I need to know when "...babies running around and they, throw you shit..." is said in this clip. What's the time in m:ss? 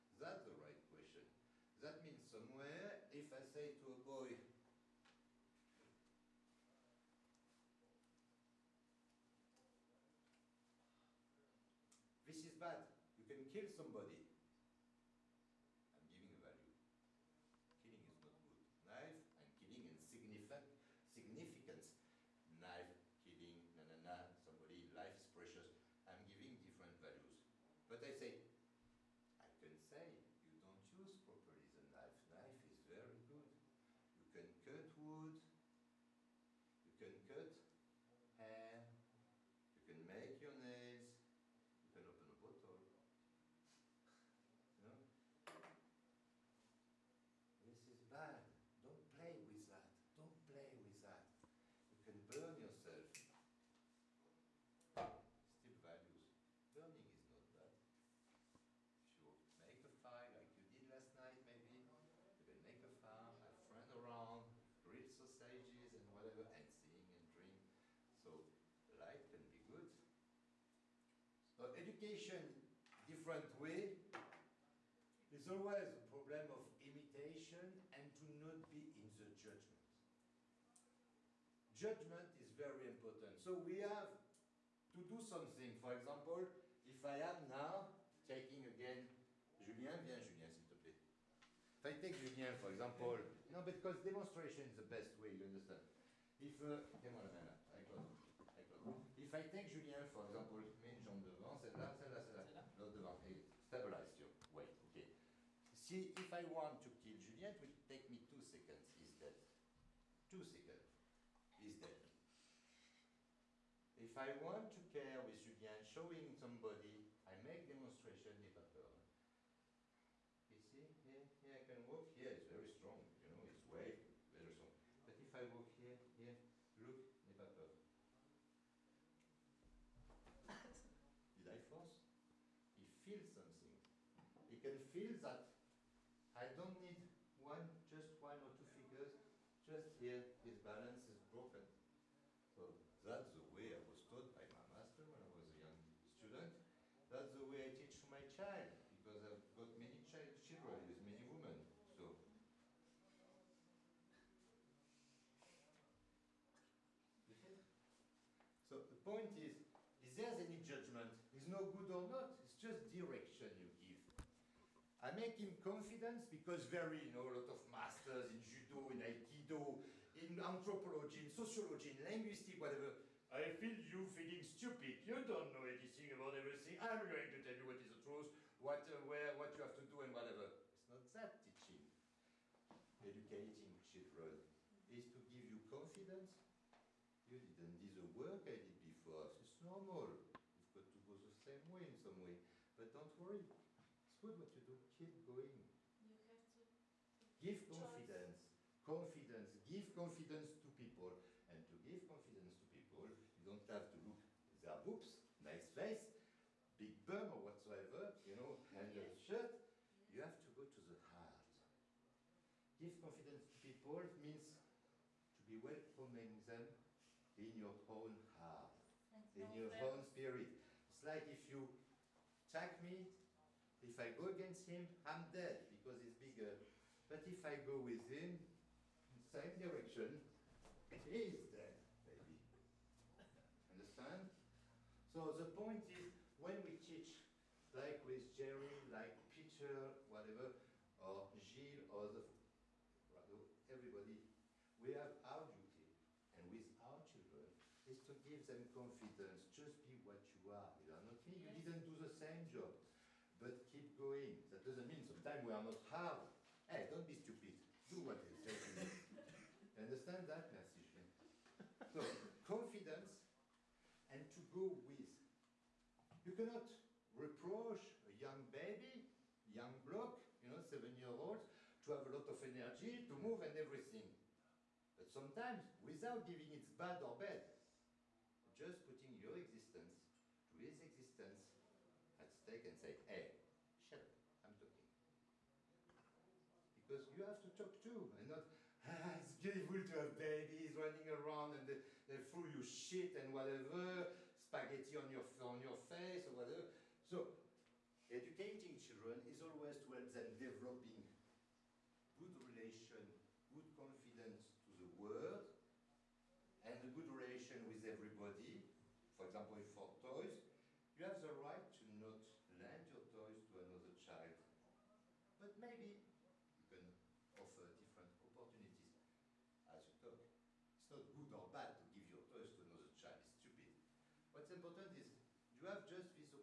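4:50.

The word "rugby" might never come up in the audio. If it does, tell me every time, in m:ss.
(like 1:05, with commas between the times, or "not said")
not said.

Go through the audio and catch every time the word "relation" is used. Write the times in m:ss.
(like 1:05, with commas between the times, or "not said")
5:02, 5:07.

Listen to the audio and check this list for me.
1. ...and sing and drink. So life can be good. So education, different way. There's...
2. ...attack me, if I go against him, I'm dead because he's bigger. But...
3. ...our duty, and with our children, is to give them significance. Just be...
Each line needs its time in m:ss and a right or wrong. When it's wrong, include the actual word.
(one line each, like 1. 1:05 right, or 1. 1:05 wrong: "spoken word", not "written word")
1. 1:06 right
2. 3:42 right
3. 4:05 wrong: "confidence", not "significance".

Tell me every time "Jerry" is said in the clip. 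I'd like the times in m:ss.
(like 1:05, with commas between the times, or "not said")
3:58.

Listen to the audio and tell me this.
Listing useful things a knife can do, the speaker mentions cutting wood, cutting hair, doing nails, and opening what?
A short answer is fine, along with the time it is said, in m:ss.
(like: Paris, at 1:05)
A bottle, at 0:42.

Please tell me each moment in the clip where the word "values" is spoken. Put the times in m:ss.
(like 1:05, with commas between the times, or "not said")
0:16, 0:26, 0:55.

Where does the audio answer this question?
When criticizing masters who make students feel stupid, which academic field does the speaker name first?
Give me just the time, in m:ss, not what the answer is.
2:50.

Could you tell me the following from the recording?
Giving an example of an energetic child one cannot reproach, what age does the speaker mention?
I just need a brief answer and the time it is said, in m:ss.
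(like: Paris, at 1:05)
7, at 4:30.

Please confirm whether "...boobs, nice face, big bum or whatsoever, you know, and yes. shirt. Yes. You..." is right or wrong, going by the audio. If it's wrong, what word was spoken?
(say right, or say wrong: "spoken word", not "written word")
right.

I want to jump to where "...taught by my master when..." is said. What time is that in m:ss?
2:24.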